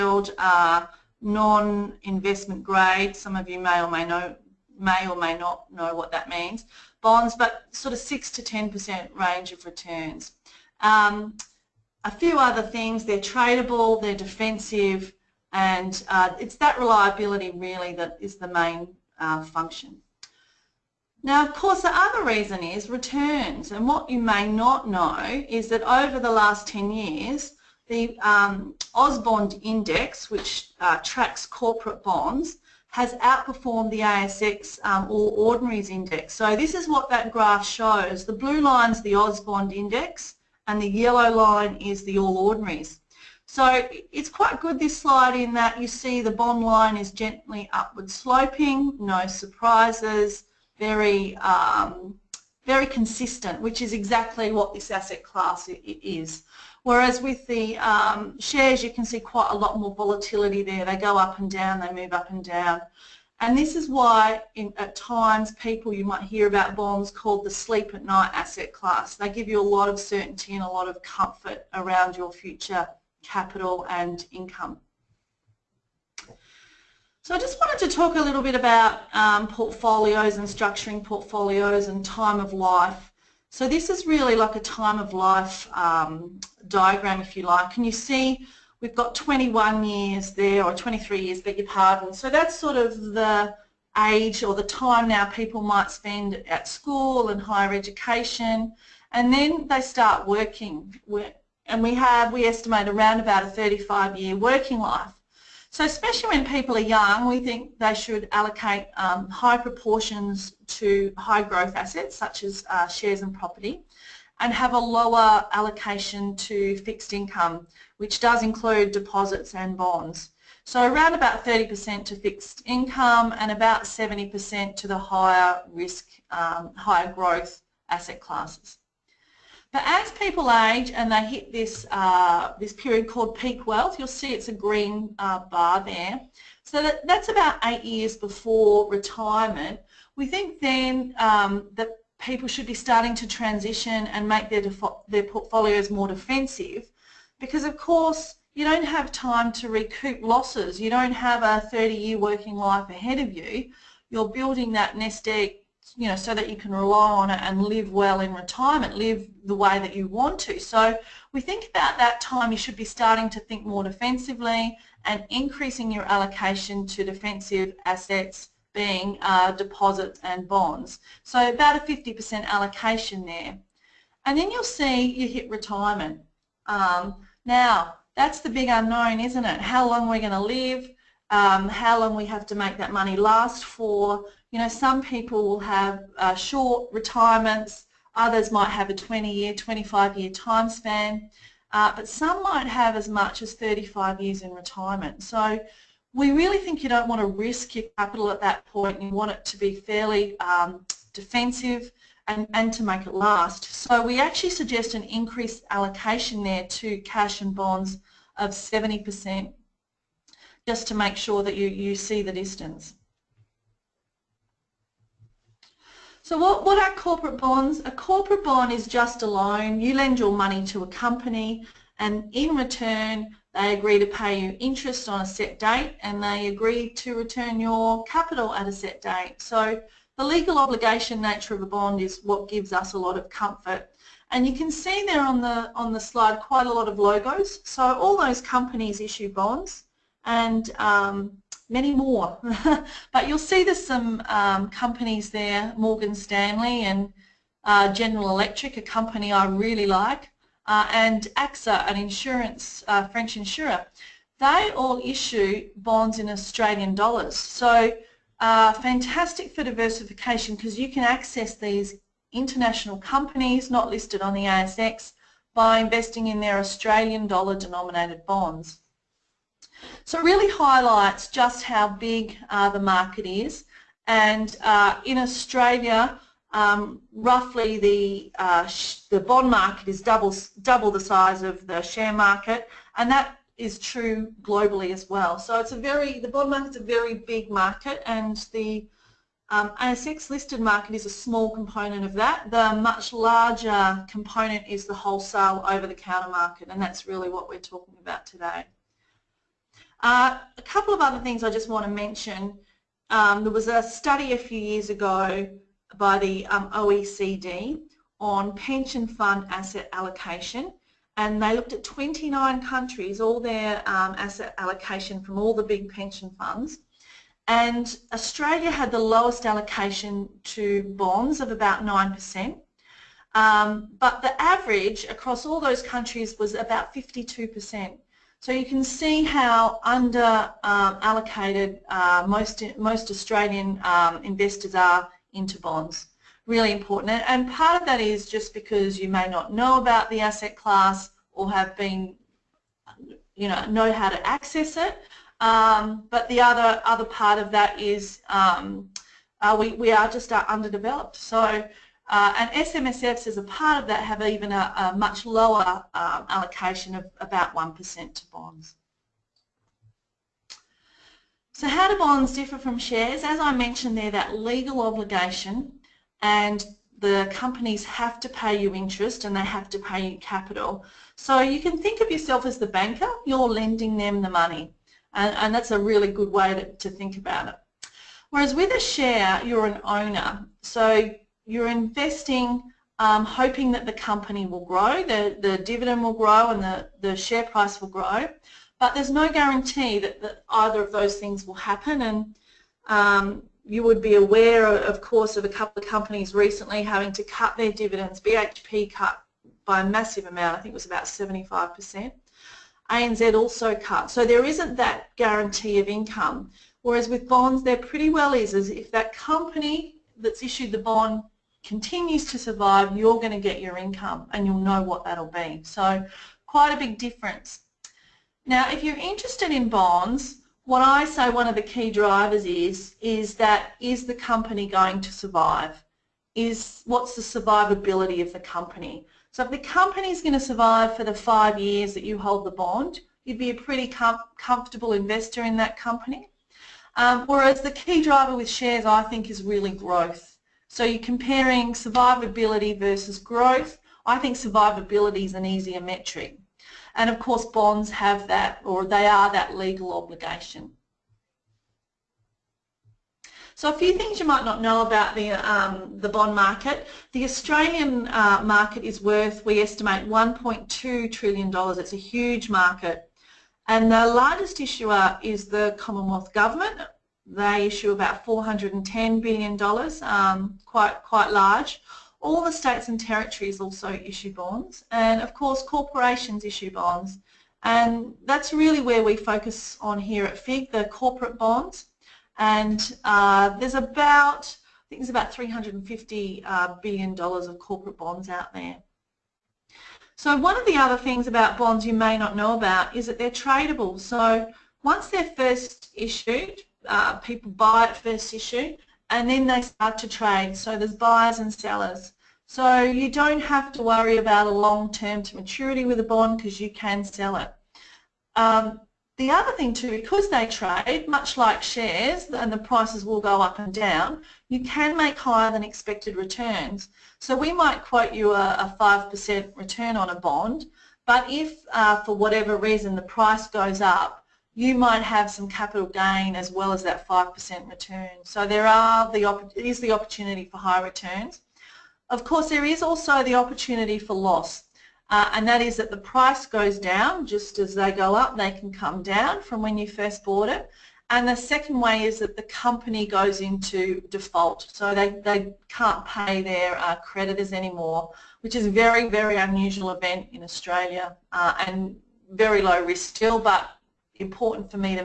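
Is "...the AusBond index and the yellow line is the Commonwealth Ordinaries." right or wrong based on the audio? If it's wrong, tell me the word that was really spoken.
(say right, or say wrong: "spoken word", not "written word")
wrong: "All", not "Commonwealth".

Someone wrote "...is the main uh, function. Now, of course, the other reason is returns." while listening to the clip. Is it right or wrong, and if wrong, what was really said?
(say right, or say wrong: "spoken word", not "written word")
right.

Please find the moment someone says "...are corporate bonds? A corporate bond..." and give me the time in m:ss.
3:36.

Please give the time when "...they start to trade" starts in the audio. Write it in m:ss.
8:19.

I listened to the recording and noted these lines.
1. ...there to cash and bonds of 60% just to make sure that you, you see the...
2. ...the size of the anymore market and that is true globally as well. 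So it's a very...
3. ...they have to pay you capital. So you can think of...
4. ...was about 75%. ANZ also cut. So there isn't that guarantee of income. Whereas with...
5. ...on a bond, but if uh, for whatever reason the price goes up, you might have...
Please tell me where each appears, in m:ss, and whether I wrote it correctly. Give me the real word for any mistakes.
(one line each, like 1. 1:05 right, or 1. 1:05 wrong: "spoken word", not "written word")
1. 3:26 wrong: "70", not "60"
2. 4:40 wrong: "share", not "anymore"
3. 6:09 right
4. 6:40 right
5. 8:39 right.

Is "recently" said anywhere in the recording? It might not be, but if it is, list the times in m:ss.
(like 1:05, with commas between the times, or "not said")
6:36.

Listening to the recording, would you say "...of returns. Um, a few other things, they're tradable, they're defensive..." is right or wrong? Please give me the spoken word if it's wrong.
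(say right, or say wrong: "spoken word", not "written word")
right.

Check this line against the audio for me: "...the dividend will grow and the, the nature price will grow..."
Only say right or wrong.
wrong.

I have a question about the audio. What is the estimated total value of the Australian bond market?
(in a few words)
$1.2 trillion.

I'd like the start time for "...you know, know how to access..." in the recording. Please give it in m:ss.
5:43.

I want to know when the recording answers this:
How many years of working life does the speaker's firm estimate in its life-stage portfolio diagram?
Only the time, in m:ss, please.
1:43.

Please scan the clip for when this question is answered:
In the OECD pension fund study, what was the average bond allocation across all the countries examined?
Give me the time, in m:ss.
5:26.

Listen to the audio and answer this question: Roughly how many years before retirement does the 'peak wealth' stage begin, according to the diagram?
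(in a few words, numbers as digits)
8 years.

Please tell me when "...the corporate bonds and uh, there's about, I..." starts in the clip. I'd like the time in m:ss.
8:00.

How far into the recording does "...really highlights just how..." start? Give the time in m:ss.
4:30.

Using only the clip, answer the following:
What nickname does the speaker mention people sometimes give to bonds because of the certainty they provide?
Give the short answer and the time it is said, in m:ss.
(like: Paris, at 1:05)
sleep at night asset class, at 1:07.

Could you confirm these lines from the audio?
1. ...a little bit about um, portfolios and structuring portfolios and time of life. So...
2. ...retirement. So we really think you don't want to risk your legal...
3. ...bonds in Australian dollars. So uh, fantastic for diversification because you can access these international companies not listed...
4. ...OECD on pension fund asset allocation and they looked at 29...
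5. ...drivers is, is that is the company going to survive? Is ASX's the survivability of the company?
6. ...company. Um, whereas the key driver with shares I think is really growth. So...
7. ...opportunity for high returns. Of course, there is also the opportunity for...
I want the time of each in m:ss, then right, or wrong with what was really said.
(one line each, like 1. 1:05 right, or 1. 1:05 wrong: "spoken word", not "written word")
1. 1:18 right
2. 3:14 wrong: "capital", not "legal"
3. 4:15 right
4. 5:06 right
5. 7:01 wrong: "What", not "ASX"
6. 7:15 right
7. 8:49 right.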